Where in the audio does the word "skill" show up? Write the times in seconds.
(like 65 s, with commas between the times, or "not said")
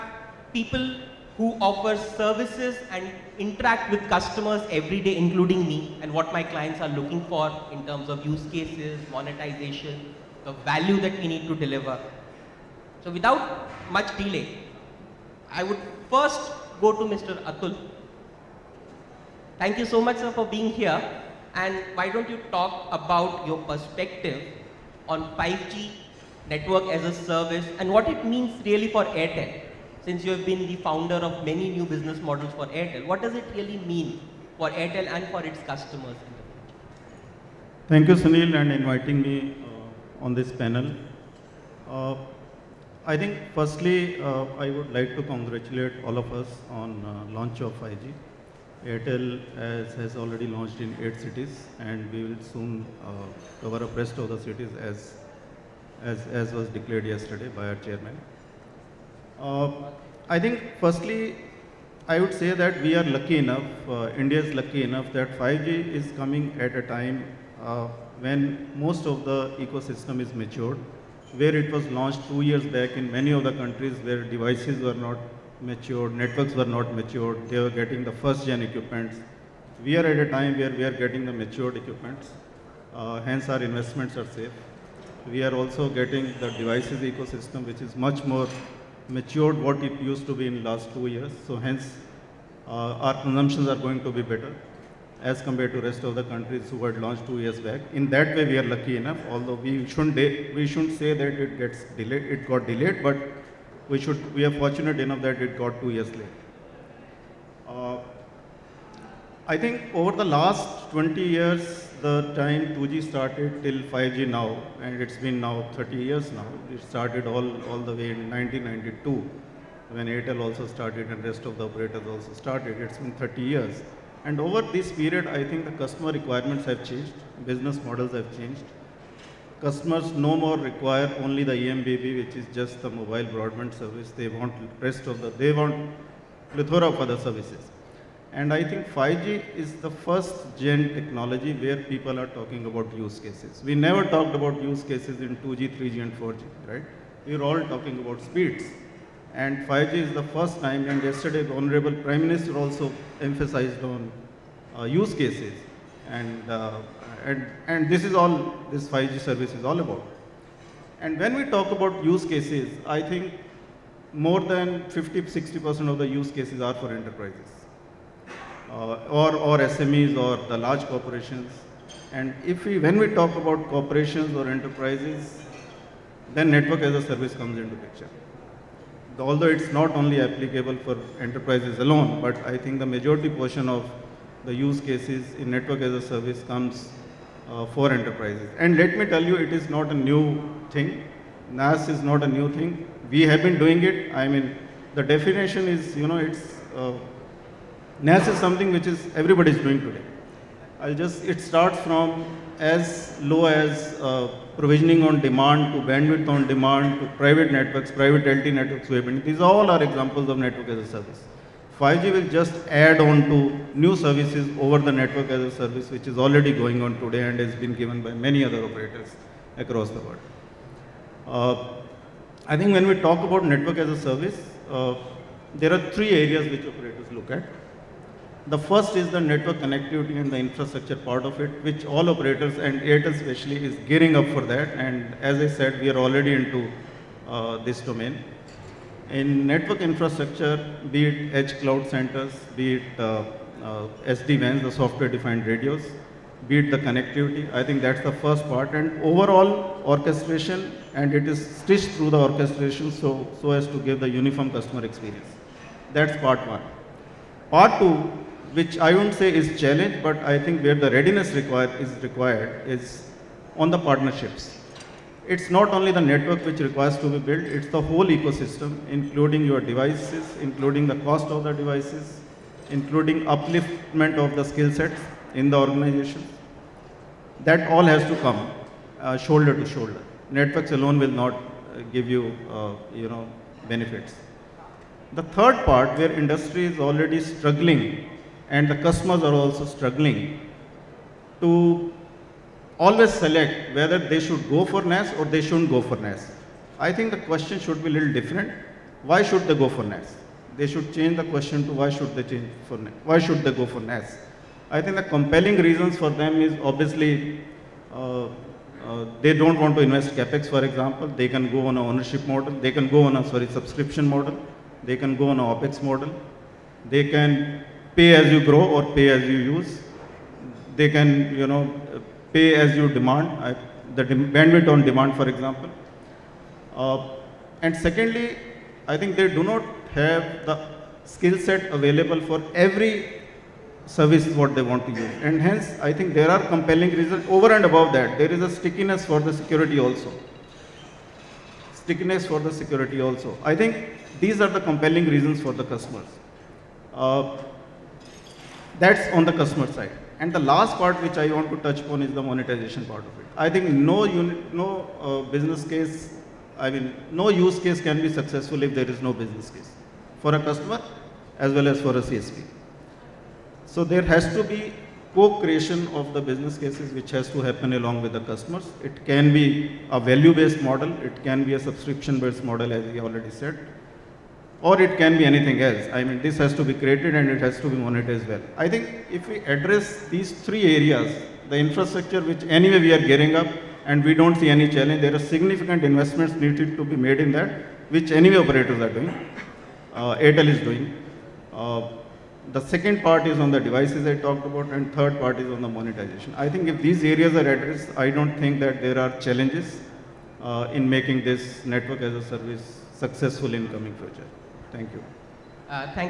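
274 s, 331 s.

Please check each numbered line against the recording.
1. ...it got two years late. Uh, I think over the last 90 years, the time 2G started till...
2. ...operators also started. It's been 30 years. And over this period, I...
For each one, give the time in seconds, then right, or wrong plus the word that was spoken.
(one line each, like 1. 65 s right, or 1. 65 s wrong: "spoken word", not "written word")
1. 105 s wrong: "20", not "90"
2. 121 s right.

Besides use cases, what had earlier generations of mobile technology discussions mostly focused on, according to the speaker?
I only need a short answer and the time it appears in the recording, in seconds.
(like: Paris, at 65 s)
speeds, at 148 s.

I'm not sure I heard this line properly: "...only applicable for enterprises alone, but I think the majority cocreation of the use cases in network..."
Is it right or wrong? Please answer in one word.
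wrong.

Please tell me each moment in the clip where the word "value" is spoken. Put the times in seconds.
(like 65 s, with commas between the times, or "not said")
10 s, 369 s.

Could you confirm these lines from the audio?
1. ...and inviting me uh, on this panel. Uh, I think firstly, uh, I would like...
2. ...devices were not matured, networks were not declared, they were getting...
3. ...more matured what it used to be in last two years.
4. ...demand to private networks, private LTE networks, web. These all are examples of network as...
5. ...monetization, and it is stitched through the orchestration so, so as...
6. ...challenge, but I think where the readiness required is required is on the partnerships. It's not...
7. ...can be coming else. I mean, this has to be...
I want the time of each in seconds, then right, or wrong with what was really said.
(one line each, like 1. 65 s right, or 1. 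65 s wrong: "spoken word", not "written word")
1. 38 s right
2. 74 s wrong: "matured", not "declared"
3. 88 s right
4. 206 s right
5. 249 s wrong: "orchestration", not "monetization"
6. 259 s right
7. 374 s wrong: "anything", not "coming".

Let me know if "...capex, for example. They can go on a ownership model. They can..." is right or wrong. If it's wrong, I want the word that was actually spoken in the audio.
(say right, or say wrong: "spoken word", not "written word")
right.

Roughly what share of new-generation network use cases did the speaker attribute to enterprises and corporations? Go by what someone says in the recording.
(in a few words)
50-60%.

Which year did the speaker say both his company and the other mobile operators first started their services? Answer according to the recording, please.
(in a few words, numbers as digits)
1992.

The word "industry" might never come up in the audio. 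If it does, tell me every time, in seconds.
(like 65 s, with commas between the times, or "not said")
286 s.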